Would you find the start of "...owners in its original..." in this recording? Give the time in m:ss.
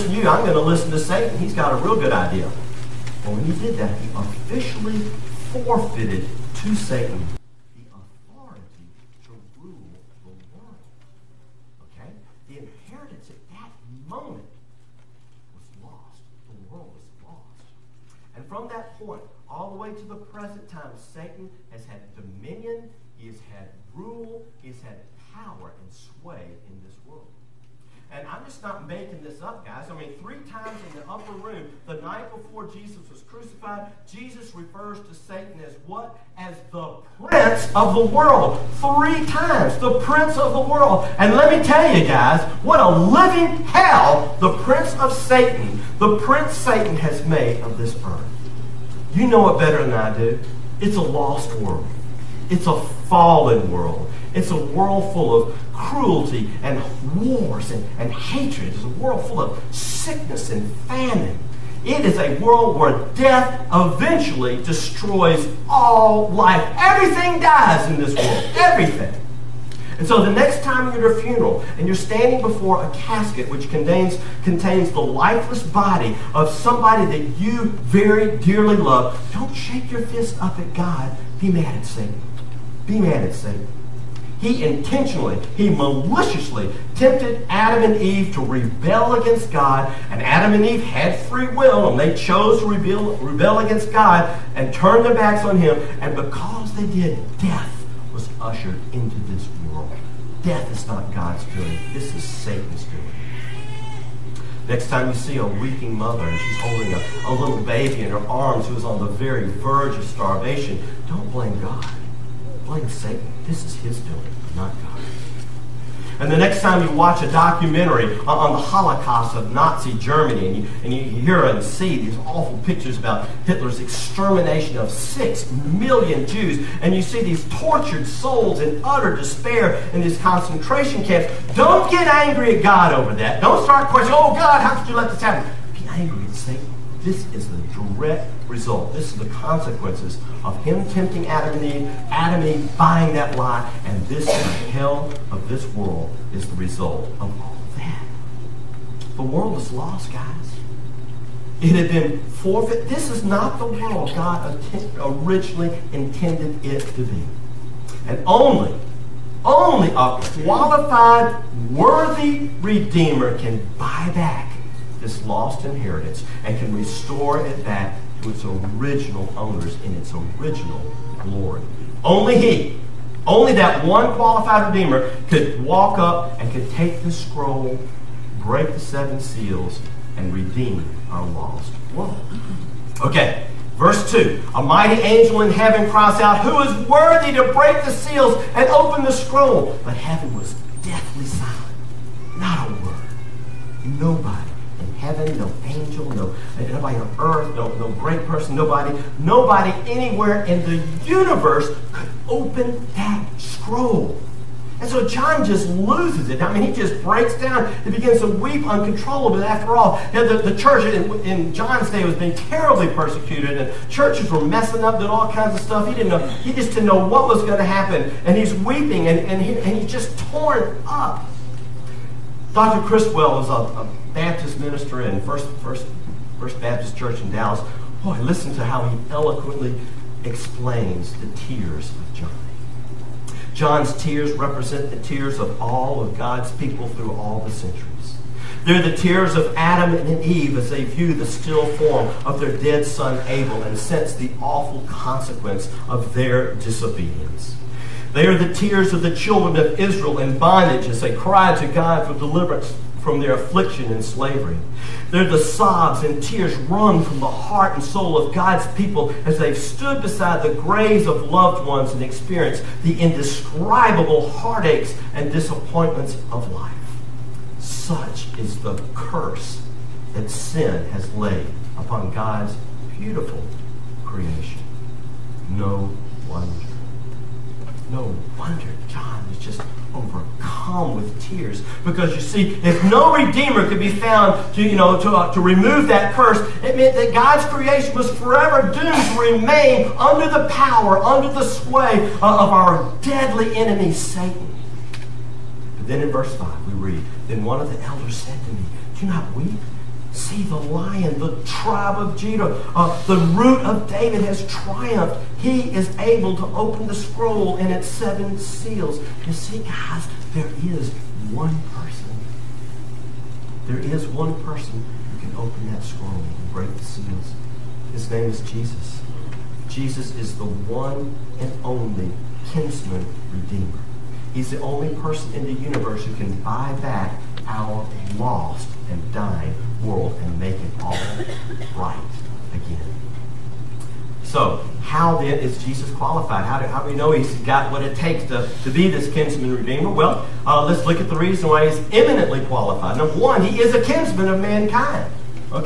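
2:49.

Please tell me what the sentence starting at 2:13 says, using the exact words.
Don't start questioning, oh God, how could you let this happen?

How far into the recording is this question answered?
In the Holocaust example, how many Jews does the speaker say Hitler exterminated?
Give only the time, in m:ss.
2:04.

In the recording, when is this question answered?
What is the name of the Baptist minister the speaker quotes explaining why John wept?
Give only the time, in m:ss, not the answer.
3:42.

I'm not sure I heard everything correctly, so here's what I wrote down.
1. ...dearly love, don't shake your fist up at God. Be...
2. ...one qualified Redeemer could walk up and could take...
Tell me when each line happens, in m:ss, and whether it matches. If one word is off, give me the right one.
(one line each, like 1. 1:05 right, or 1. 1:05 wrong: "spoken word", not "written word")
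1. 1:18 right
2. 2:53 right.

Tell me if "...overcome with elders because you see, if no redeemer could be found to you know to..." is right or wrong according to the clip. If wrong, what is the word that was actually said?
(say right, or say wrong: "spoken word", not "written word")
wrong: "tears", not "elders".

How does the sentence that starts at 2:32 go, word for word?
This is not the world God originally intended it to be.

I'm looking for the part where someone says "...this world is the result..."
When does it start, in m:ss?
2:25.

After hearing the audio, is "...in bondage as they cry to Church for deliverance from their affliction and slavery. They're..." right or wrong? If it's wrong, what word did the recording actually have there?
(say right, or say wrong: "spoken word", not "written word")
wrong: "God", not "Church".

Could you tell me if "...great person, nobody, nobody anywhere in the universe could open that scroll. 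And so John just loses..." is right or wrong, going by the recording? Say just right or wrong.
right.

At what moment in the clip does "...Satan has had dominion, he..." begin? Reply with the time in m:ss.
0:20.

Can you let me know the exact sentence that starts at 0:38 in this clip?
Three times, the prince of the world.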